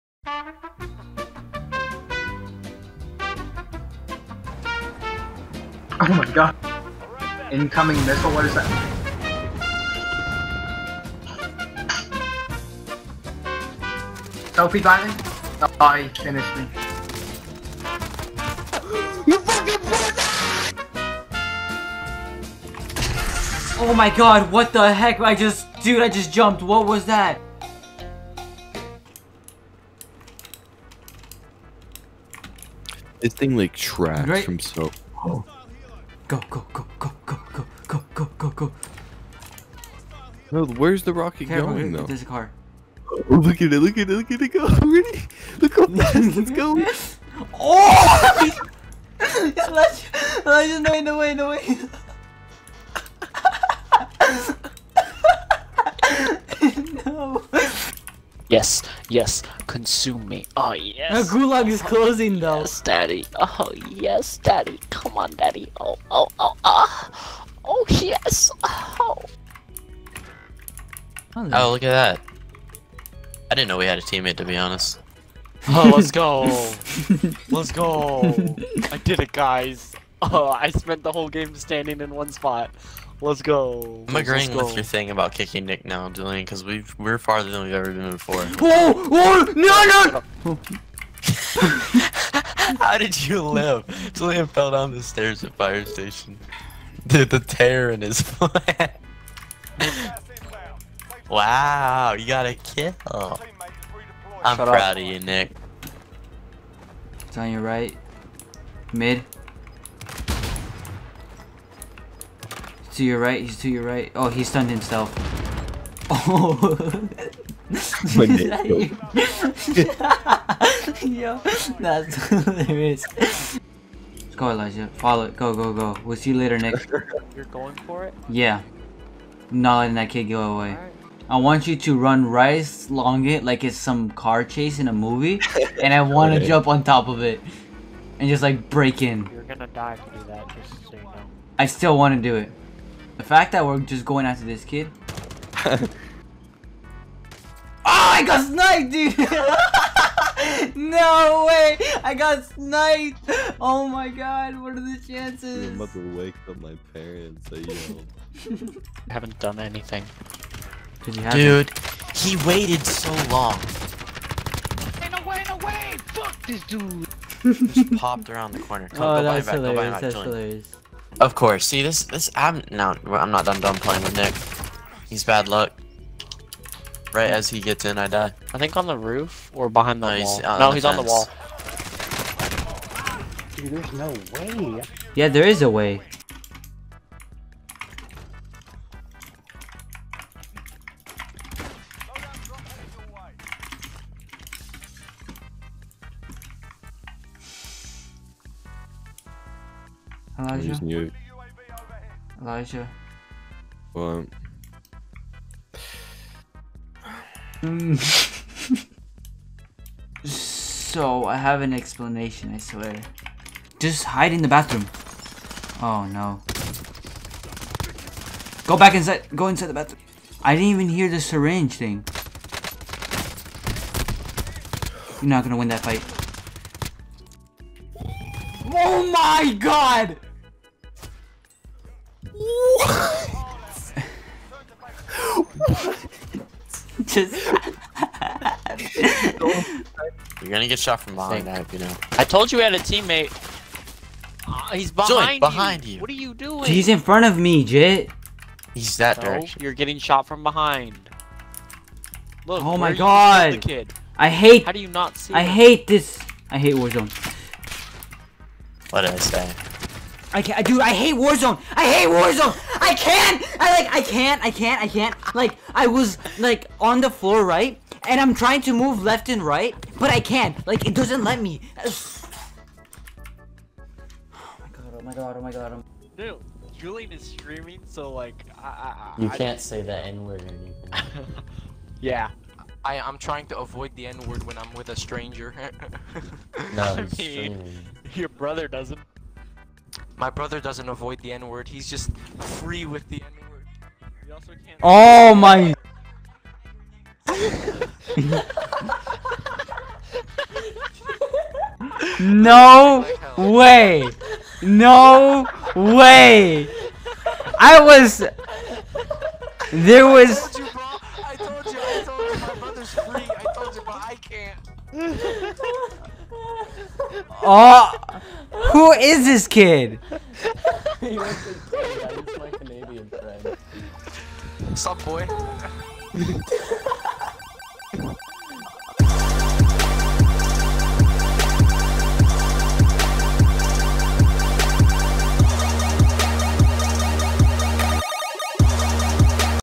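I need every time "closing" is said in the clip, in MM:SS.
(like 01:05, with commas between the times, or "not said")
01:01.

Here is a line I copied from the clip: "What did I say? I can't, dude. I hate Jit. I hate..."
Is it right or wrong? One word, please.
wrong.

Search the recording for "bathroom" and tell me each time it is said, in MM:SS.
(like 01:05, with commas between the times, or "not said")
03:34, 03:39.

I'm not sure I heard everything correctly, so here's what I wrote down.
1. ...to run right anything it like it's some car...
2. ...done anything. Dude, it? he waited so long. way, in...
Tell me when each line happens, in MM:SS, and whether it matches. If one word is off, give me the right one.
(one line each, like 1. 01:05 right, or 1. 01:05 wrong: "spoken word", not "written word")
1. 02:11 wrong: "along", not "anything"
2. 02:39 right.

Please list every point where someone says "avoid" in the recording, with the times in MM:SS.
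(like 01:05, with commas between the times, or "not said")
04:43, 04:50.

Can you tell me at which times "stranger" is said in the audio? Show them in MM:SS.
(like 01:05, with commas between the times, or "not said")
04:44.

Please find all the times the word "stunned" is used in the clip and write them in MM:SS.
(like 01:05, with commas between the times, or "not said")
01:54.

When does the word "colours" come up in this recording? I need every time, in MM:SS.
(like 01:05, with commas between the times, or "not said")
not said.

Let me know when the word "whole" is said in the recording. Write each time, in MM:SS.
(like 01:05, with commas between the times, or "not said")
01:21.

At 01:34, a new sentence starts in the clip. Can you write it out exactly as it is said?
Julian fell down the stairs at fire station.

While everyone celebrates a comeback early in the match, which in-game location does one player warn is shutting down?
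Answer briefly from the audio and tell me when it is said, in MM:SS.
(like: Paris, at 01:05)
The gulag, at 01:01.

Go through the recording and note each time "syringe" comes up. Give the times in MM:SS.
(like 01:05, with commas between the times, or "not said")
03:41.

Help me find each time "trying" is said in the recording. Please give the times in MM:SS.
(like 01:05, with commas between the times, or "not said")
04:28, 04:43.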